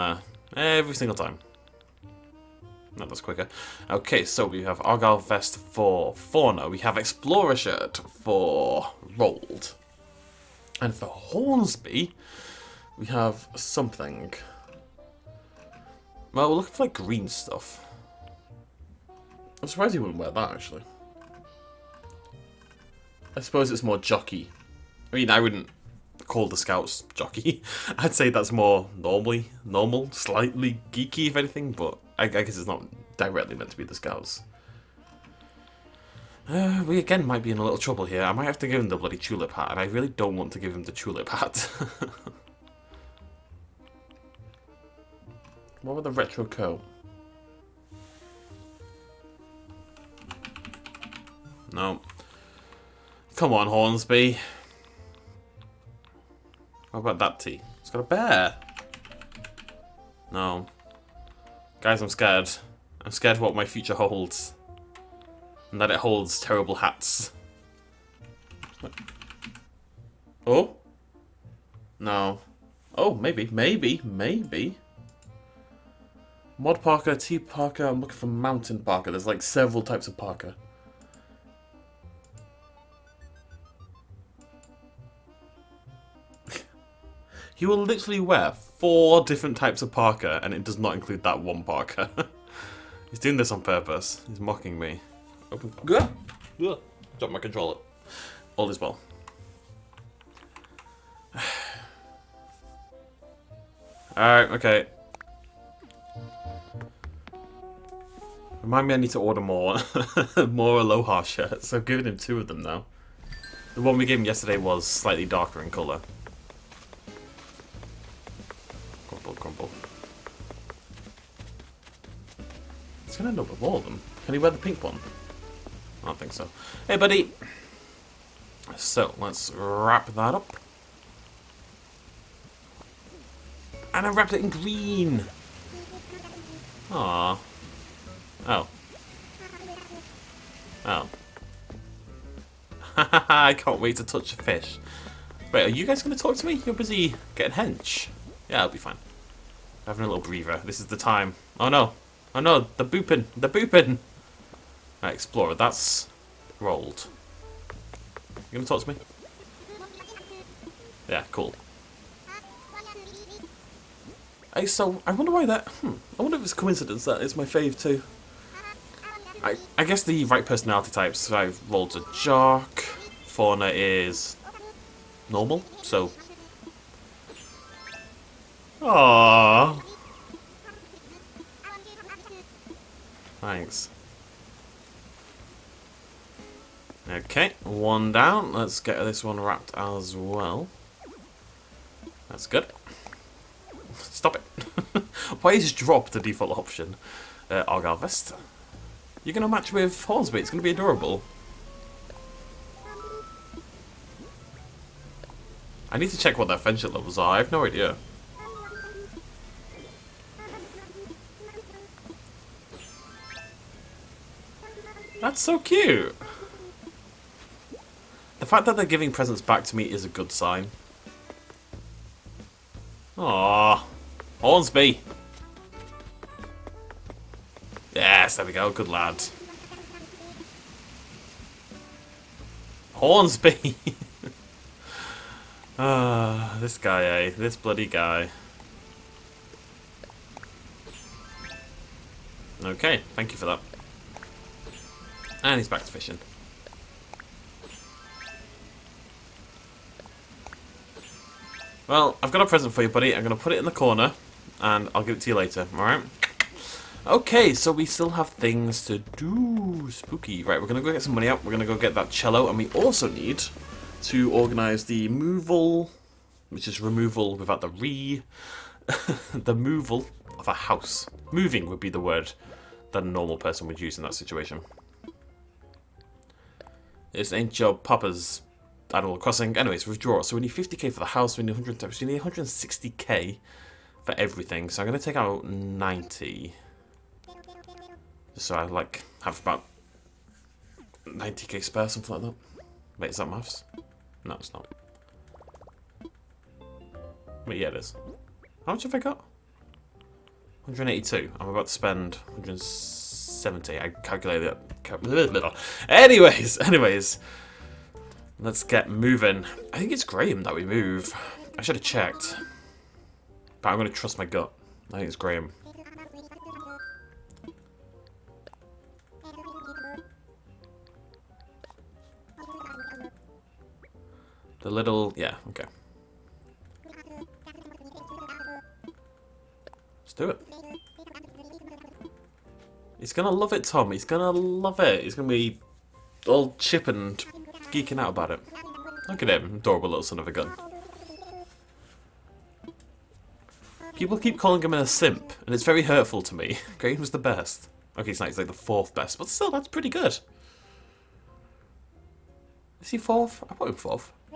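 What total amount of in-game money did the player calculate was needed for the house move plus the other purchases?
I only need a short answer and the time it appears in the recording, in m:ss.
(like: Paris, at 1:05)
160k, at 4:42.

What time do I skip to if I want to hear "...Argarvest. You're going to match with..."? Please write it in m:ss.
3:17.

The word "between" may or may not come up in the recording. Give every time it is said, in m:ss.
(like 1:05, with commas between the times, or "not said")
not said.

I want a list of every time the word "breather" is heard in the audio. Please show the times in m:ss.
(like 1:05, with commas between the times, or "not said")
2:30.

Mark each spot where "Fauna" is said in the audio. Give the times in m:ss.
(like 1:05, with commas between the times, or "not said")
0:06, 2:53.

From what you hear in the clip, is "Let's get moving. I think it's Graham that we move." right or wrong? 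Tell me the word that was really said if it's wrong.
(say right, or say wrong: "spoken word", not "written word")
right.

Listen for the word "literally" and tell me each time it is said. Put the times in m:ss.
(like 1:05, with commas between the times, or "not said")
1:27.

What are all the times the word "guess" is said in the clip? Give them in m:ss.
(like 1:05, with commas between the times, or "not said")
0:32, 2:49.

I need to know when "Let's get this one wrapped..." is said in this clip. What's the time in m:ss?
3:08.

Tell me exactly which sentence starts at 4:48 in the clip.
so I like have about 90k spare, something like that.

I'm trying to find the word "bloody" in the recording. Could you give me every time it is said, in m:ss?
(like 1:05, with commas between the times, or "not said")
0:38, 3:57.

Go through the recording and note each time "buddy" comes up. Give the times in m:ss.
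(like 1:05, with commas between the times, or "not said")
2:06, 4:12.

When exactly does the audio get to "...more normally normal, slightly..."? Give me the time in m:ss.
0:28.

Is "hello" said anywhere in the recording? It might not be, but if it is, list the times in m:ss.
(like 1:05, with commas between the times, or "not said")
not said.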